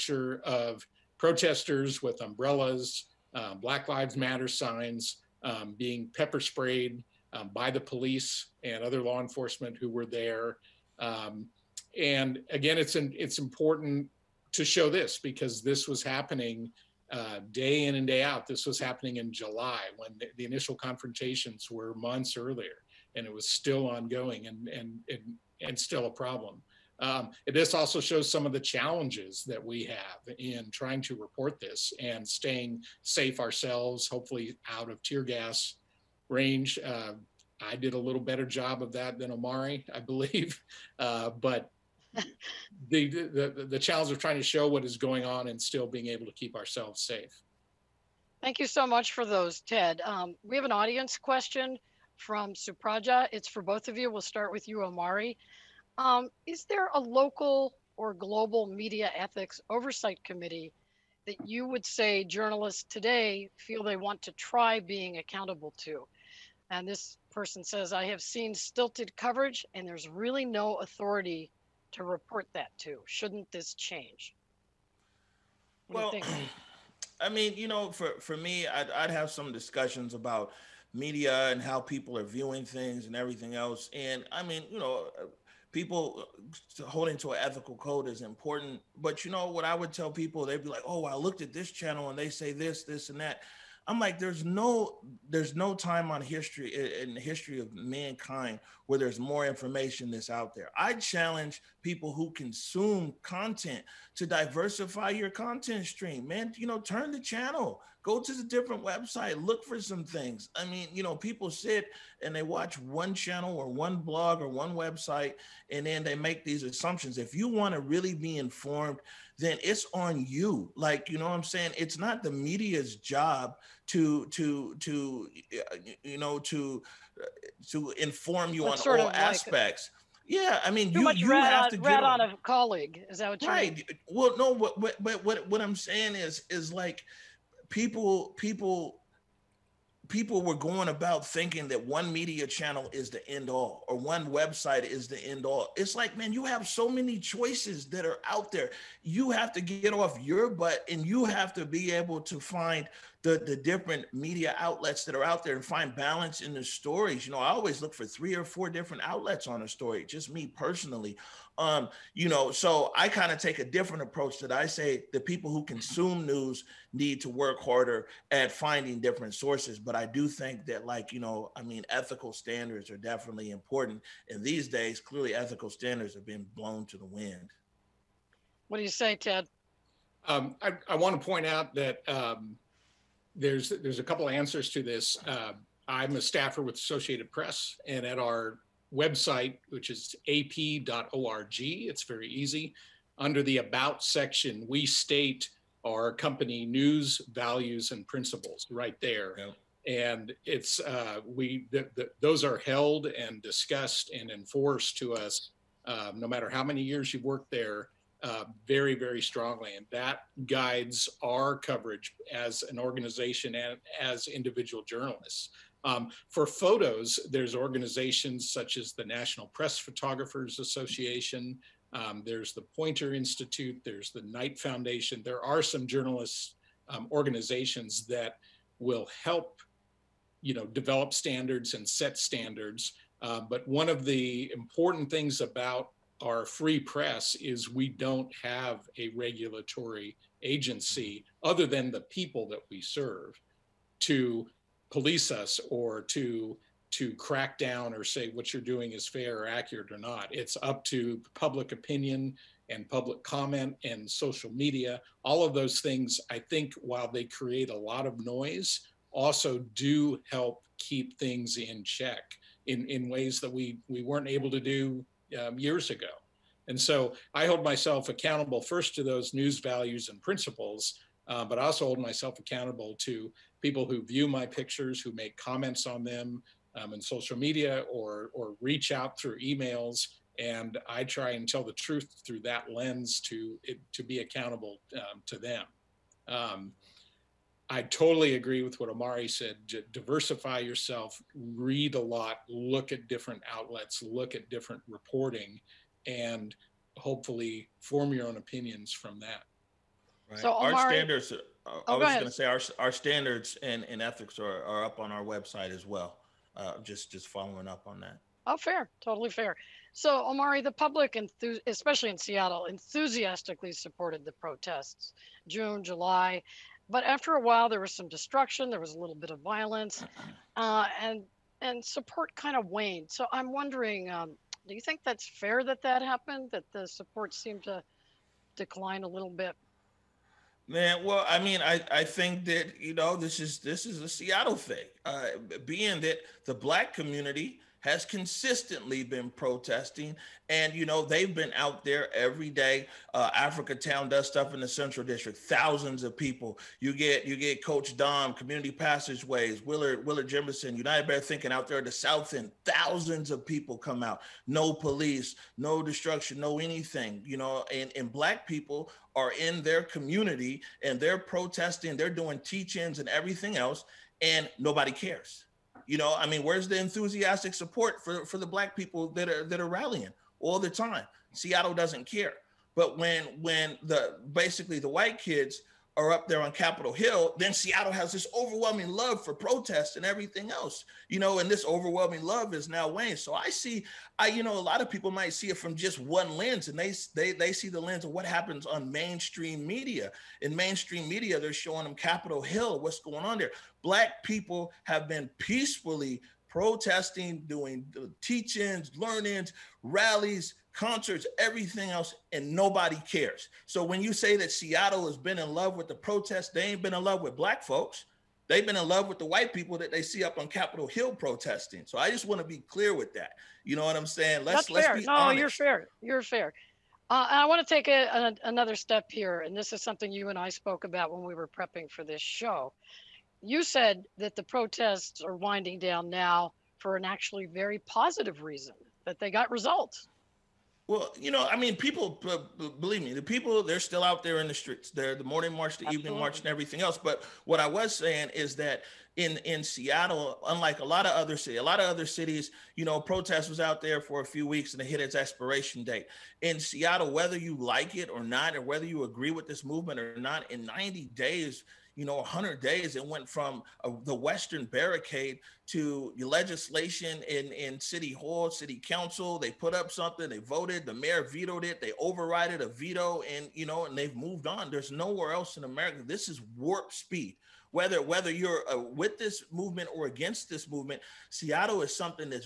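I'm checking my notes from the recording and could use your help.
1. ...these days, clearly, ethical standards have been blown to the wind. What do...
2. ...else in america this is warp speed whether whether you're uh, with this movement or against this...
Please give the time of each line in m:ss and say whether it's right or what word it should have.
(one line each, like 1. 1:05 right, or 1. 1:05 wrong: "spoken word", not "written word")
1. 2:54 right
2. 7:45 right.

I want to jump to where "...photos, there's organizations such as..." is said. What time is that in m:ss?
3:36.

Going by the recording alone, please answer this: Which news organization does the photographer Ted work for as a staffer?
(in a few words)
Associated Press.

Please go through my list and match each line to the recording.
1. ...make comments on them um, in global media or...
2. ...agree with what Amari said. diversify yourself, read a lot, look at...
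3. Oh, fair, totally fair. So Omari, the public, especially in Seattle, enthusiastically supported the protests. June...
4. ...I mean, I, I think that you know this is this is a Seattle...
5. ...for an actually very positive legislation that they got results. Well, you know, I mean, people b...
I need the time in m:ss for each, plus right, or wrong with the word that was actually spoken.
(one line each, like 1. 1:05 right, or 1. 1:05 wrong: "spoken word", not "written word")
1. 4:35 wrong: "social", not "global"
2. 4:48 right
3. 5:08 right
4. 5:31 right
5. 7:06 wrong: "reason", not "legislation".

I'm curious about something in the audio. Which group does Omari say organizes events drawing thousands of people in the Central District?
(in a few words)
Africatown.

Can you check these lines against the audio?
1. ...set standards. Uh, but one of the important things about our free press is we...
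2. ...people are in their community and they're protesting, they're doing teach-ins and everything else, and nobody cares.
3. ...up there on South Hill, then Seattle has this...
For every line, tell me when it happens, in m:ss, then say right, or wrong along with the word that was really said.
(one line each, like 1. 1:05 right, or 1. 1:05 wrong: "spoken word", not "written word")
1. 3:51 right
2. 5:58 right
3. 6:16 wrong: "Capitol", not "South".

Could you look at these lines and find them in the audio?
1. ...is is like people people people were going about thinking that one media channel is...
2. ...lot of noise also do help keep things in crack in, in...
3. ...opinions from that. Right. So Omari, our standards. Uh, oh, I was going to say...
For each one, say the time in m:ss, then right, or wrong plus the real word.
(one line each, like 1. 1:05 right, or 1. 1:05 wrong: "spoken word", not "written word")
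1. 2:16 right
2. 4:17 wrong: "check", not "crack"
3. 4:58 right.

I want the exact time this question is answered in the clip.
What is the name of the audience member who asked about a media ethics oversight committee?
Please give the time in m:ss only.
0:52.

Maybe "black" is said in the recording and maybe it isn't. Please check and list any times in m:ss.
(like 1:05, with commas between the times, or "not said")
0:03, 5:36, 5:58, 6:08, 6:33, 6:47.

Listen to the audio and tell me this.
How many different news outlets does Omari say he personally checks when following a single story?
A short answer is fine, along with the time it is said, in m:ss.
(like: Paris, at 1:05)
3 or 4, at 2:38.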